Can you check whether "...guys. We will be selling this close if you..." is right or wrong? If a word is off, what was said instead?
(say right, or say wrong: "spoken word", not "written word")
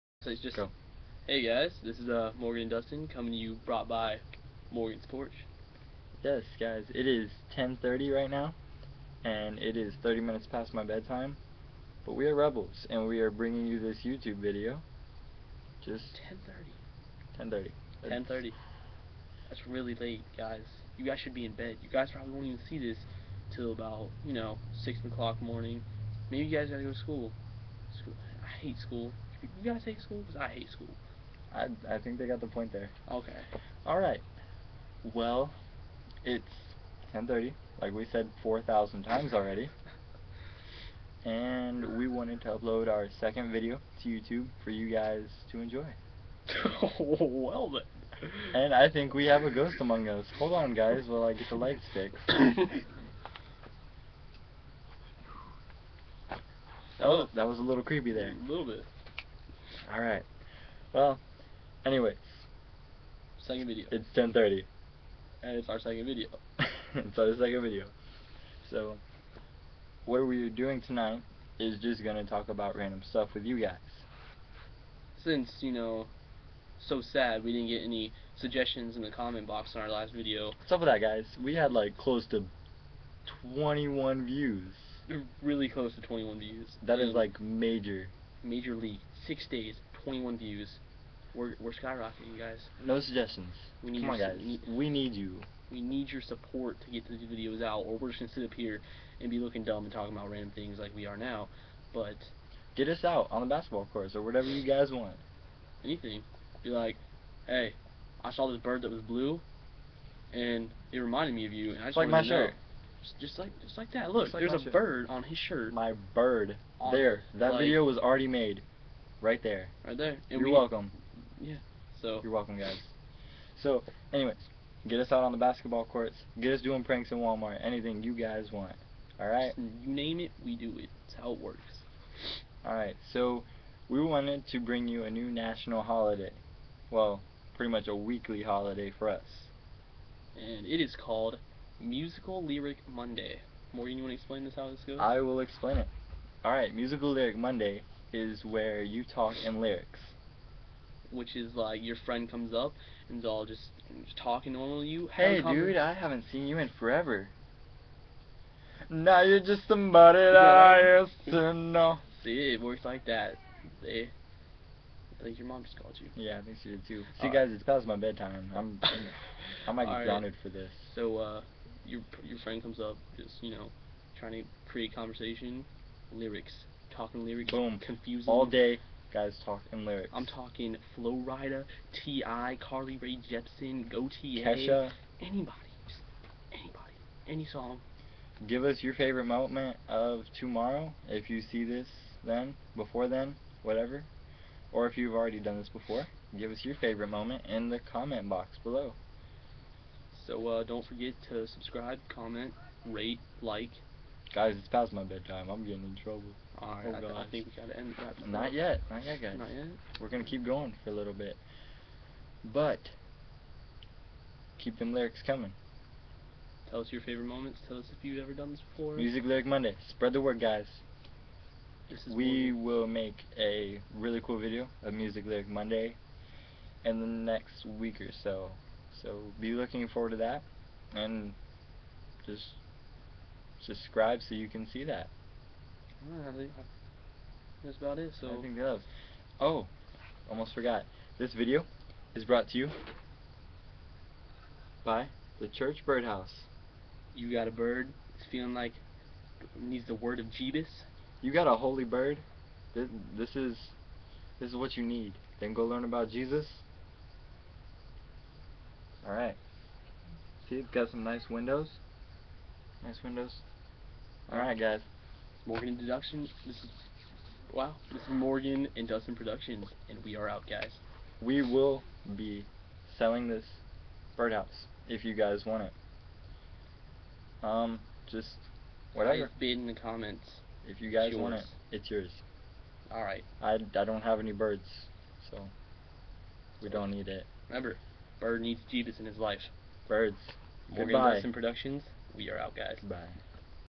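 wrong: "birdhouse", not "close".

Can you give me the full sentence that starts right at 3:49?
So be looking forward to that.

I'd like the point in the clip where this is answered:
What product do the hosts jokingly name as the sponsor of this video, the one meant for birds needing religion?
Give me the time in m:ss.
4:05.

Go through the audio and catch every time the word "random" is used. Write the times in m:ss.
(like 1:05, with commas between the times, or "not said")
1:12, 1:40.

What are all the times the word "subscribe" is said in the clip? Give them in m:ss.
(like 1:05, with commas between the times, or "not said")
3:21, 3:53.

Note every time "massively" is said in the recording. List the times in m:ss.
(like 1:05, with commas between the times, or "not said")
not said.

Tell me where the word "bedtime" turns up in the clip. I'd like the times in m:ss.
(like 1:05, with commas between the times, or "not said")
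0:10, 2:47, 3:25.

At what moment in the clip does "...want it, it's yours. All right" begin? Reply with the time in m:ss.
4:41.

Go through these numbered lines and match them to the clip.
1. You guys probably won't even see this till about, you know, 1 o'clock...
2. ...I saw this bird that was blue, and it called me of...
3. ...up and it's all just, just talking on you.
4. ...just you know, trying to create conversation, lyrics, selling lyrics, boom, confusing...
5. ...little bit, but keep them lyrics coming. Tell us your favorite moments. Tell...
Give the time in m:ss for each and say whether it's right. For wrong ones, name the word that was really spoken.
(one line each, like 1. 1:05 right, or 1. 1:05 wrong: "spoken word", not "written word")
1. 0:21 wrong: "6", not "1"
2. 1:48 wrong: "reminded", not "called"
3. 2:32 right
4. 2:53 wrong: "talking", not "selling"
5. 3:30 right.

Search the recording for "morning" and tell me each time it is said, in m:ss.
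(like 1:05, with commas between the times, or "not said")
0:25, 3:42.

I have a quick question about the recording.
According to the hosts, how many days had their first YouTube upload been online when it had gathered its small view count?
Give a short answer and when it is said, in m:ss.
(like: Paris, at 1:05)
6, at 1:29.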